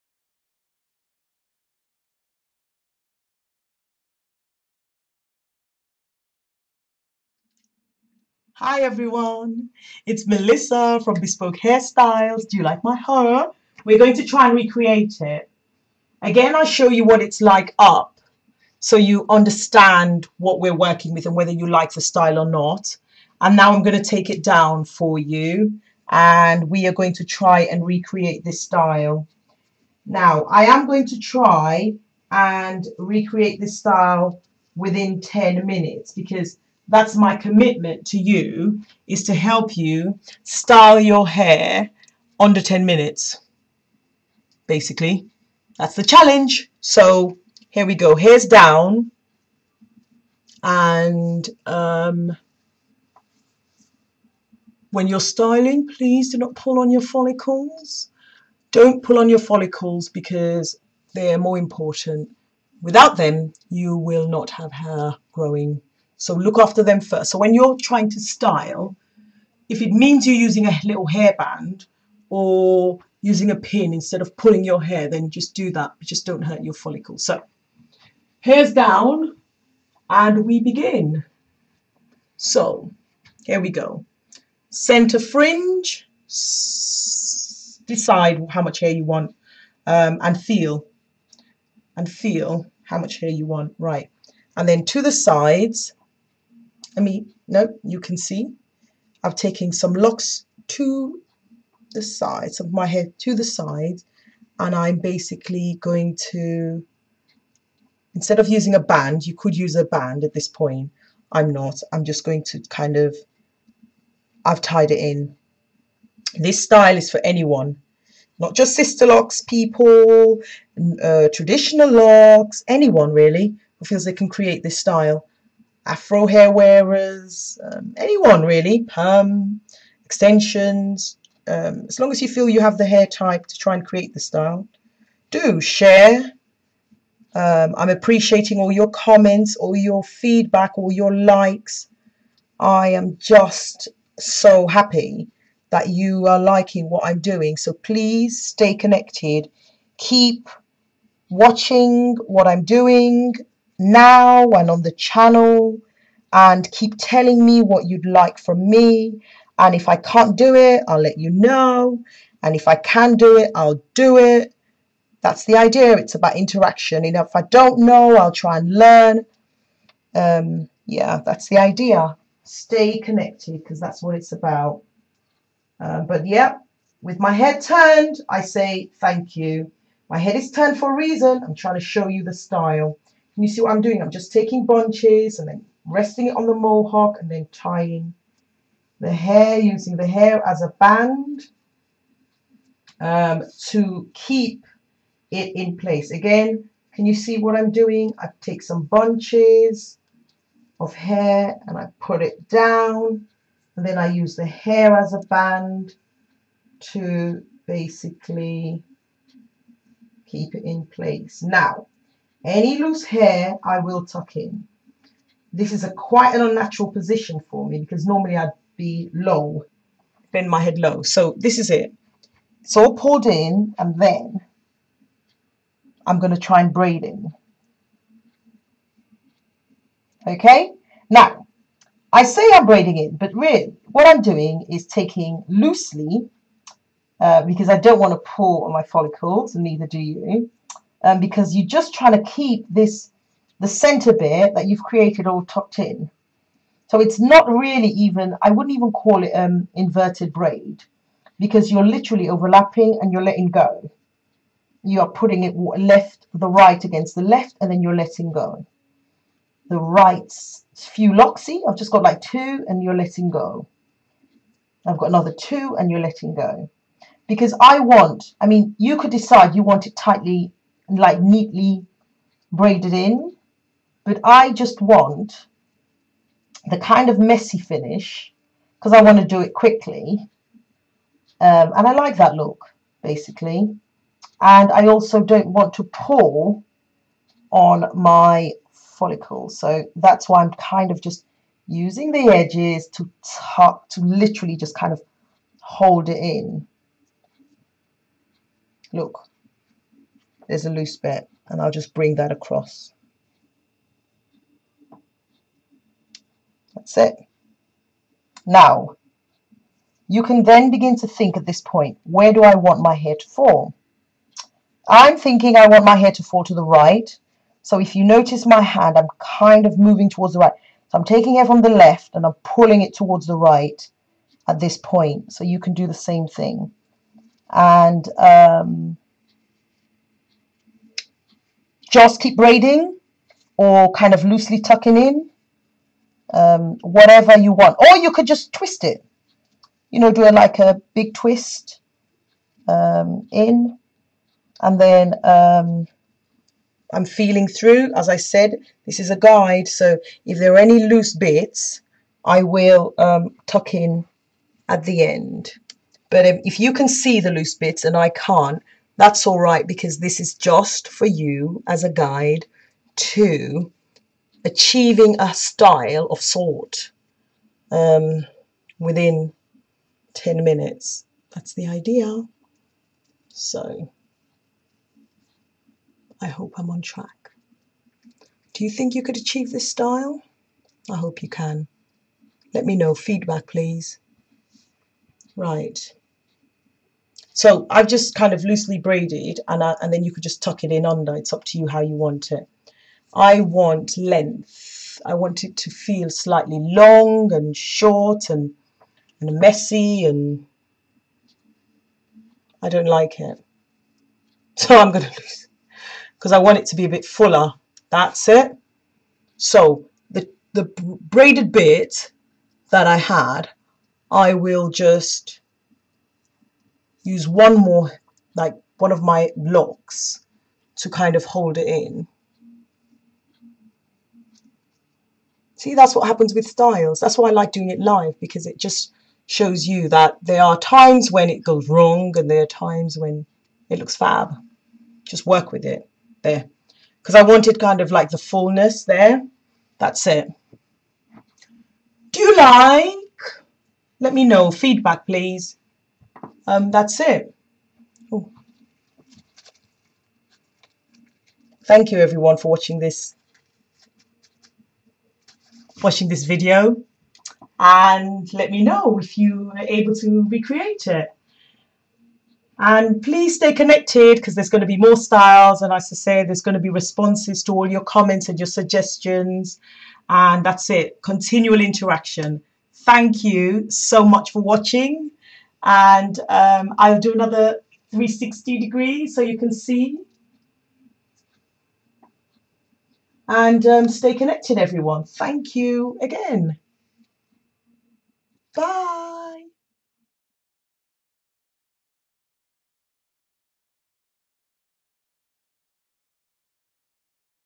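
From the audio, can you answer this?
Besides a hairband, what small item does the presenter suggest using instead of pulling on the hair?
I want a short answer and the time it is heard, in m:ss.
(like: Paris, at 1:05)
a pin, at 1:13.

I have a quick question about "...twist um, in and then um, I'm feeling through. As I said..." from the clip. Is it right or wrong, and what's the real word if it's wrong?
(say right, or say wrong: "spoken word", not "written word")
right.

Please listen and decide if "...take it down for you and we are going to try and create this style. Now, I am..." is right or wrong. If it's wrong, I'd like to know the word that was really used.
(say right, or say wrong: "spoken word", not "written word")
wrong: "recreate", not "create".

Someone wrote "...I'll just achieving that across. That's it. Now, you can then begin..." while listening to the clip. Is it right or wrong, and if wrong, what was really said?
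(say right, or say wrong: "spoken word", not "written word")
wrong: "bring", not "achieving".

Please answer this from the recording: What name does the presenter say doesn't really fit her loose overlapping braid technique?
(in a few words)
inverted braid.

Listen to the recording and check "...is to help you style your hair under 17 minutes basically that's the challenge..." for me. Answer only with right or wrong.
wrong.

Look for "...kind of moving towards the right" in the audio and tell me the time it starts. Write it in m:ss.
5:19.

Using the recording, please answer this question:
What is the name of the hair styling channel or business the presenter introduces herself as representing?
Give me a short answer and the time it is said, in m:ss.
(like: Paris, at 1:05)
Bespoke Hairstyles, at 0:11.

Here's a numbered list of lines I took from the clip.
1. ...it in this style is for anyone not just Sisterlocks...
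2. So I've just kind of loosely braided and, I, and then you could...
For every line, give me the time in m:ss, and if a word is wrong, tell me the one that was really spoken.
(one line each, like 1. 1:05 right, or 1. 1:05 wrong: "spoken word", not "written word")
1. 1:54 right
2. 6:27 right.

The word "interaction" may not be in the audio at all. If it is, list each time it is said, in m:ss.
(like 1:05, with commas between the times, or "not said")
2:46, 7:51.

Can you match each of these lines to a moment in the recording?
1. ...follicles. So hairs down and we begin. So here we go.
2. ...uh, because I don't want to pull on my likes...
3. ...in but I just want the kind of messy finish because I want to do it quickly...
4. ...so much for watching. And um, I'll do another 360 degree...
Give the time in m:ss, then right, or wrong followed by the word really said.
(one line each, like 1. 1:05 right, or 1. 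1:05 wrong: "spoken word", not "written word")
1. 1:16 right
2. 3:57 wrong: "follicles", not "likes"
3. 4:32 right
4. 7:53 right.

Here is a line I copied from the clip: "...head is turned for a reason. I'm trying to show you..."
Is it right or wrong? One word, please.
right.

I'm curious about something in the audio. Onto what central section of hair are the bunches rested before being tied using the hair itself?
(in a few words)
mohawk.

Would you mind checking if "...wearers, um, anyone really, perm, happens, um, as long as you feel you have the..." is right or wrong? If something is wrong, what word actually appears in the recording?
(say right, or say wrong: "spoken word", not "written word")
wrong: "extensions", not "happens".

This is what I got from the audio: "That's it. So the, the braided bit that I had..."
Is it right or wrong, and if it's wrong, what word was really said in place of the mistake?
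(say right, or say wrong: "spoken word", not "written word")
right.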